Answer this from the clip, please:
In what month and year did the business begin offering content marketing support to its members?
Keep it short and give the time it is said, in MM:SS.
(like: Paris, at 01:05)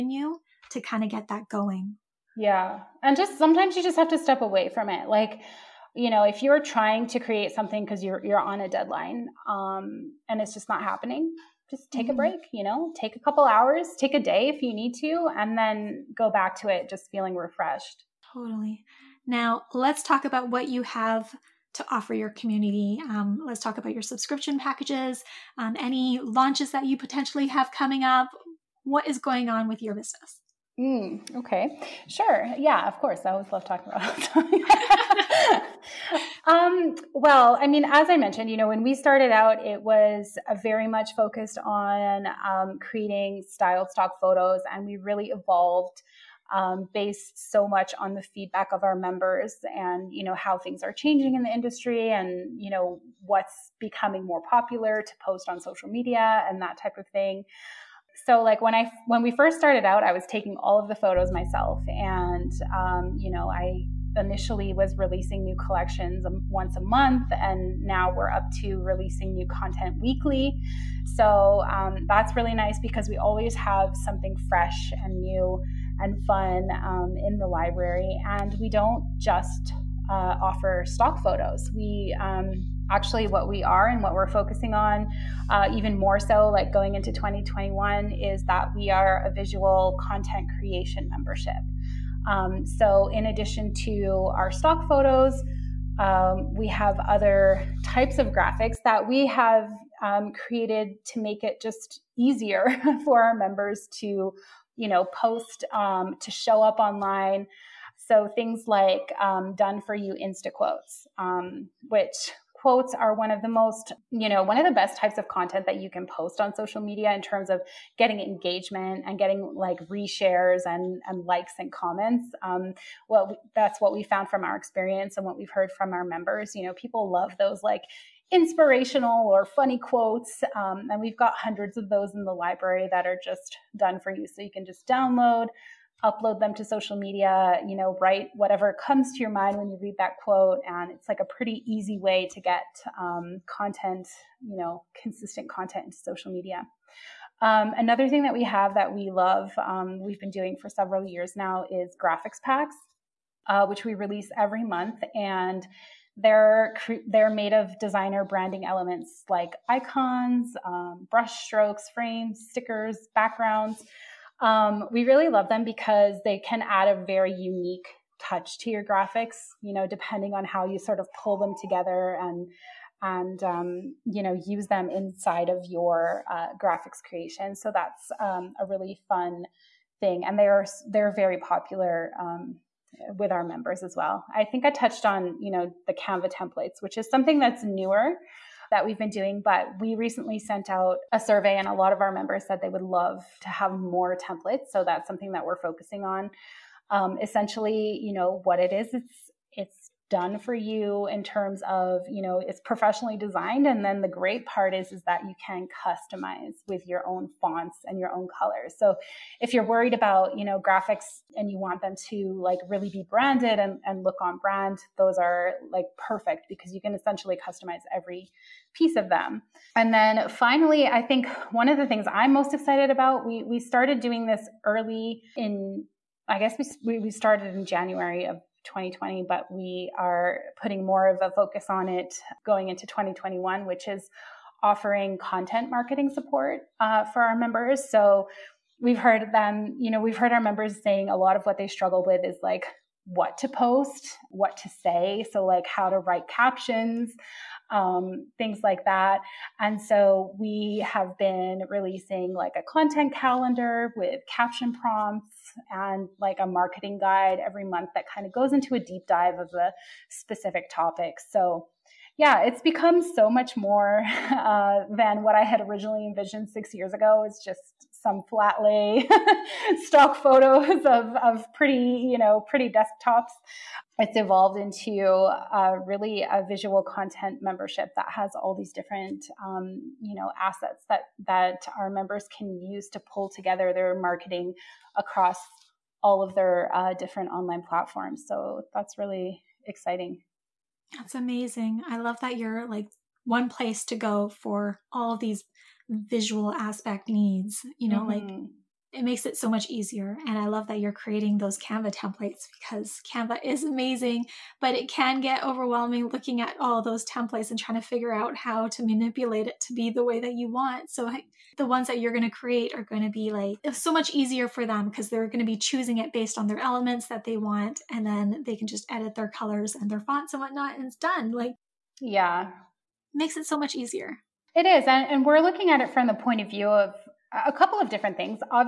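January 2020, at 03:47.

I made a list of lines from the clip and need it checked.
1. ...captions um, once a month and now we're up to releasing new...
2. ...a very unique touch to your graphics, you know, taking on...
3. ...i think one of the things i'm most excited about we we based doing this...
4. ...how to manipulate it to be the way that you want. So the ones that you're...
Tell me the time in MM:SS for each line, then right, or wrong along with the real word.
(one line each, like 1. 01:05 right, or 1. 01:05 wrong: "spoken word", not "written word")
1. 01:05 wrong: "collections", not "captions"
2. 02:46 wrong: "depending", not "taking"
3. 03:40 wrong: "started", not "based"
4. 05:08 right.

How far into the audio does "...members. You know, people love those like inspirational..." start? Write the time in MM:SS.
02:06.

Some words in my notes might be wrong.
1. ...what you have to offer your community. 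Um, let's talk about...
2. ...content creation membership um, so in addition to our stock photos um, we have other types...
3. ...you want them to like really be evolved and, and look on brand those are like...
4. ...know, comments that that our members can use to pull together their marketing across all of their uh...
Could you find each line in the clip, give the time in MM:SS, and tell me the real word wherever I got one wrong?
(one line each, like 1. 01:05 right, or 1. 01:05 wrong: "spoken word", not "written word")
1. 00:20 right
2. 01:29 right
3. 03:31 wrong: "branded", not "evolved"
4. 04:40 wrong: "assets", not "comments".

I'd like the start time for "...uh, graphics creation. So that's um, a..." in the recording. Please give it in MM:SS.
02:56.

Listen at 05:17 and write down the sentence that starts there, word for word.
And then they can just edit their colors and their fonts and whatnot, and it's done.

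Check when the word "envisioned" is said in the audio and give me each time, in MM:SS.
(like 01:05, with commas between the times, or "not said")
04:26.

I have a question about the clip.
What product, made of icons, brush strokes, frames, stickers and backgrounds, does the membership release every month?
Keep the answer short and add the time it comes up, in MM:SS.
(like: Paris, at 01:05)
Graphics packs, at 02:31.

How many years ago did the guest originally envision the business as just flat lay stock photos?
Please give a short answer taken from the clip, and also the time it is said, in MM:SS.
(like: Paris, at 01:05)
6, at 04:26.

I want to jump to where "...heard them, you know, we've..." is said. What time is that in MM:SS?
03:58.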